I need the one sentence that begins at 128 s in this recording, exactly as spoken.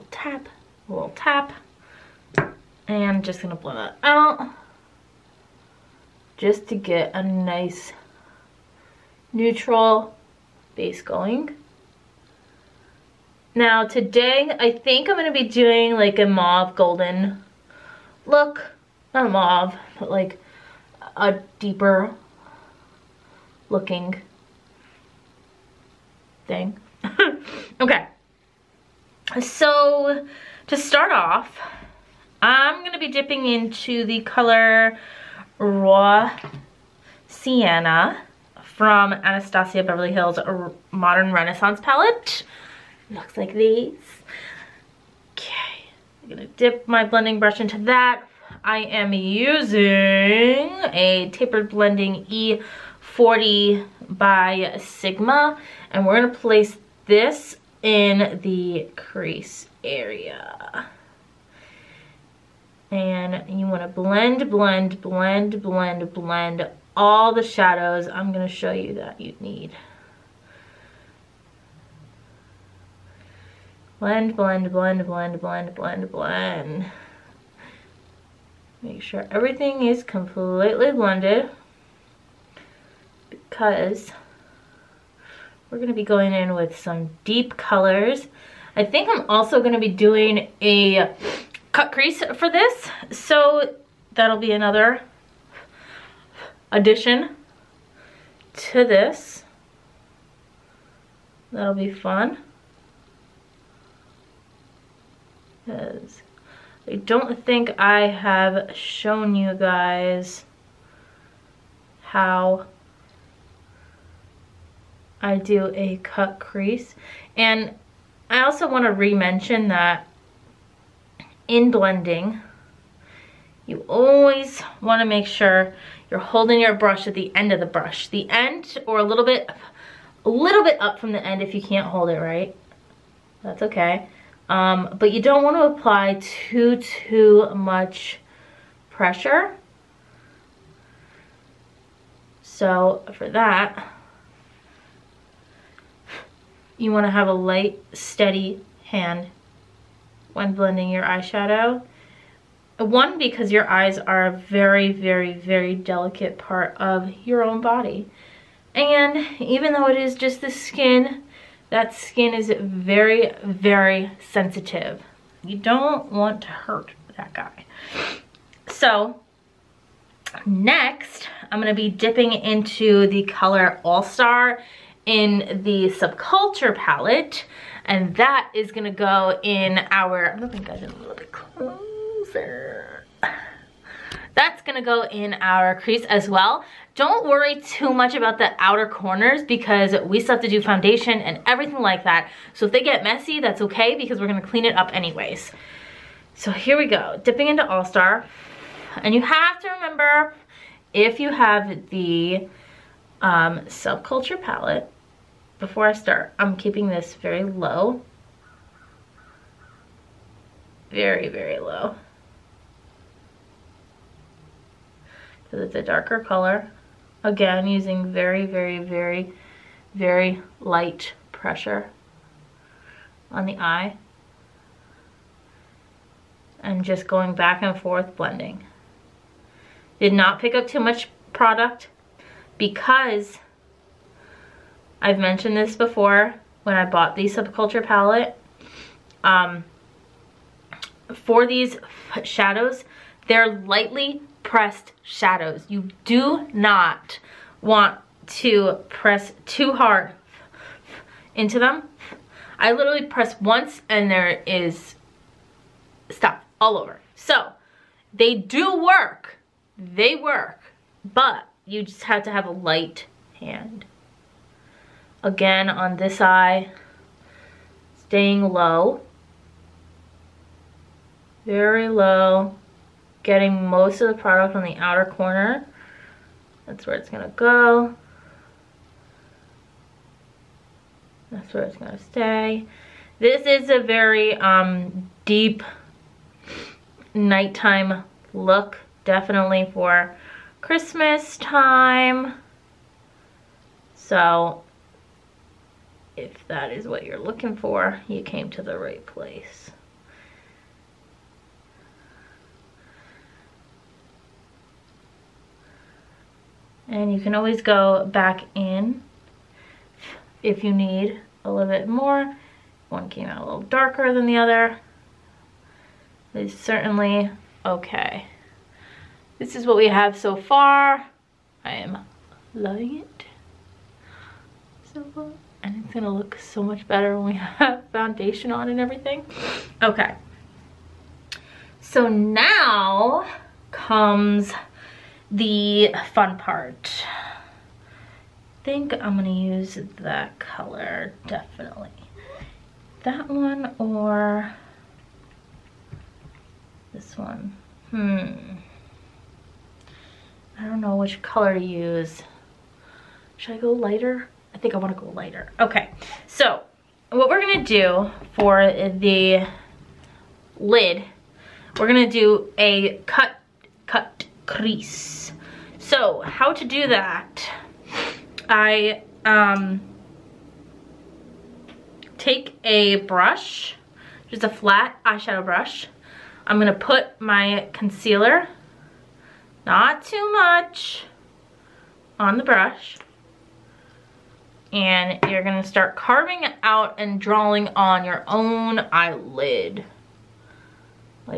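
The end or a little bit, a little bit up from the end if you can't hold it right.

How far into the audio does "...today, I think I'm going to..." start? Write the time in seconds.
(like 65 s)
13 s.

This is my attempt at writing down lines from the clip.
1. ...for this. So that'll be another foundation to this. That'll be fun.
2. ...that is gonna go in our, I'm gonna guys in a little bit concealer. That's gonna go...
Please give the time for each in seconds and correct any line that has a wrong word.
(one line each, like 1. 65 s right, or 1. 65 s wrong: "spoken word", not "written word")
1. 92 s wrong: "addition", not "foundation"
2. 178 s wrong: "closer", not "concealer".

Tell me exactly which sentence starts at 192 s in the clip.
So if they get messy, that's okay because we're gonna clean it up anyways.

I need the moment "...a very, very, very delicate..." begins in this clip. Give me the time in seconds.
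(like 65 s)
154 s.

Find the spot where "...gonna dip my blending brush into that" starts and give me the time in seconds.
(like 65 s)
46 s.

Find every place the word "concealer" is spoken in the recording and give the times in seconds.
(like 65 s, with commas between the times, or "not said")
377 s.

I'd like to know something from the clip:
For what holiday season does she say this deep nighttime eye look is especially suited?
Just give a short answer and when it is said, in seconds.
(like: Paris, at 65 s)
Christmas, at 290 s.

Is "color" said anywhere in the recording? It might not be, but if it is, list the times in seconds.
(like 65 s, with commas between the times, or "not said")
34 s, 87 s, 173 s, 216 s, 340 s, 351 s.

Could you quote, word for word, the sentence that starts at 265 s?
Again, on this eye, staying low.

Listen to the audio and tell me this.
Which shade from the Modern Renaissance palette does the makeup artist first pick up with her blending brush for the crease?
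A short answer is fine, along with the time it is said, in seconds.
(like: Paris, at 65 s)
Raw Sienna, at 35 s.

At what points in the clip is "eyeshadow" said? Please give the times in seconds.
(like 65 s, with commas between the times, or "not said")
151 s, 375 s.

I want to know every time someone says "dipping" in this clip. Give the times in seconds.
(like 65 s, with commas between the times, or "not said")
33 s, 171 s, 197 s.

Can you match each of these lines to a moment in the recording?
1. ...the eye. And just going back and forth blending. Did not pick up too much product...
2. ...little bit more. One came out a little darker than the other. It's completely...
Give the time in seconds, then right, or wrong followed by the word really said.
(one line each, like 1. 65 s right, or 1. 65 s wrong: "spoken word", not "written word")
1. 223 s right
2. 311 s wrong: "certainly", not "completely".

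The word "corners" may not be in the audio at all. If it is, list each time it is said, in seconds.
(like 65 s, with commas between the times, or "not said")
188 s, 275 s.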